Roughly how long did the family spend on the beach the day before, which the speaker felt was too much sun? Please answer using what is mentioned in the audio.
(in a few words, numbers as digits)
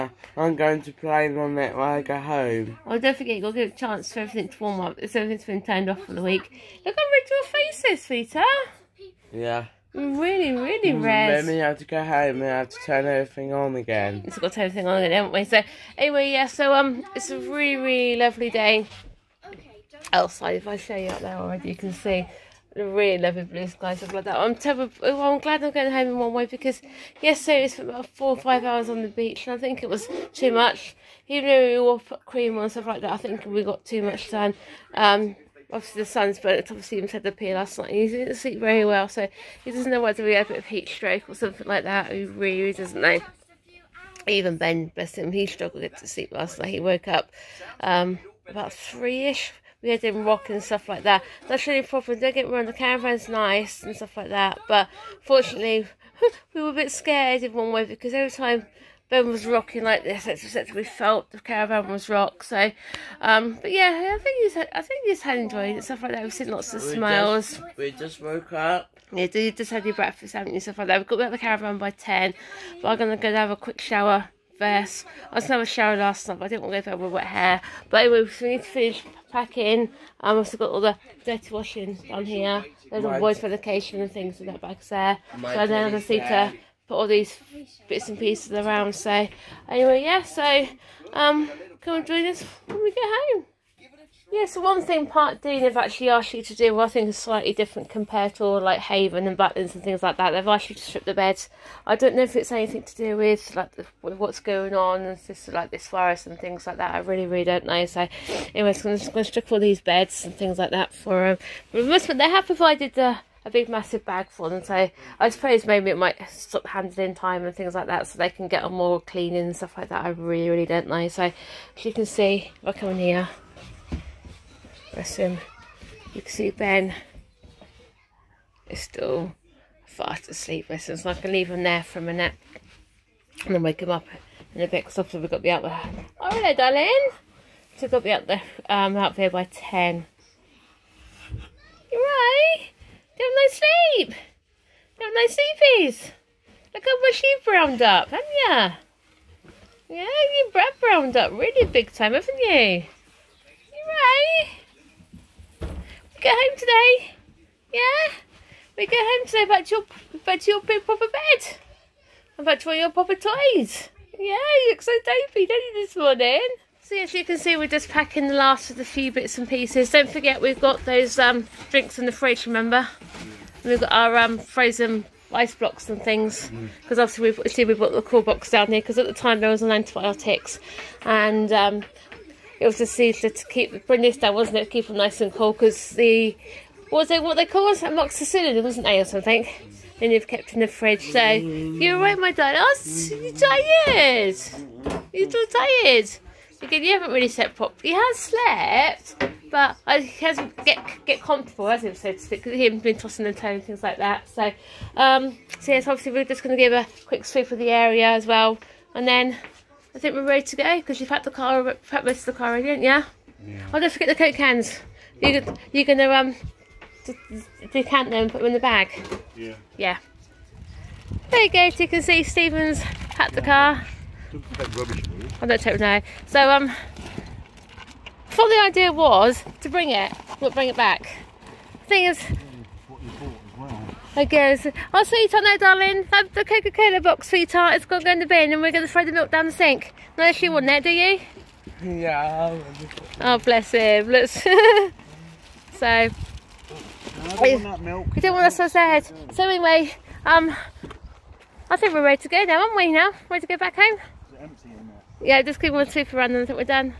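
4 or 5 hours.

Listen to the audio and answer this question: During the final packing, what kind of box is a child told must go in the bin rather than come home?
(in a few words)
Coca-Cola box.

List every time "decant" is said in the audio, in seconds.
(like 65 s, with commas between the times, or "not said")
217 s.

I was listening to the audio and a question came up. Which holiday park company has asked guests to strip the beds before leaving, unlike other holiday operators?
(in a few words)
Park Dean.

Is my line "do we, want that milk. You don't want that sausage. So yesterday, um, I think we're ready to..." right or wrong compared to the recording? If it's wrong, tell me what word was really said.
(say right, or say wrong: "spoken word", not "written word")
wrong: "anyway", not "yesterday".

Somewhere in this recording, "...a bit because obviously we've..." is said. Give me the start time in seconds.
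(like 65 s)
134 s.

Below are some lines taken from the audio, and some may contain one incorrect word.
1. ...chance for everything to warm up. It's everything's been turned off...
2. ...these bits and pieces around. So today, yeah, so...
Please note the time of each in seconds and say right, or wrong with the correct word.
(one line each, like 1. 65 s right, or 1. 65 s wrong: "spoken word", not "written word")
1. 3 s right
2. 87 s wrong: "anyway", not "today".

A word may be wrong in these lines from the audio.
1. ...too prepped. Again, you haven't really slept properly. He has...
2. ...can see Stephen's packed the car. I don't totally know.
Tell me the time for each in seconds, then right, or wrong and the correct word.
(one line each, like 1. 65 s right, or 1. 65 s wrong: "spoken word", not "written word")
1. 195 s wrong: "tired", not "prepped"
2. 221 s right.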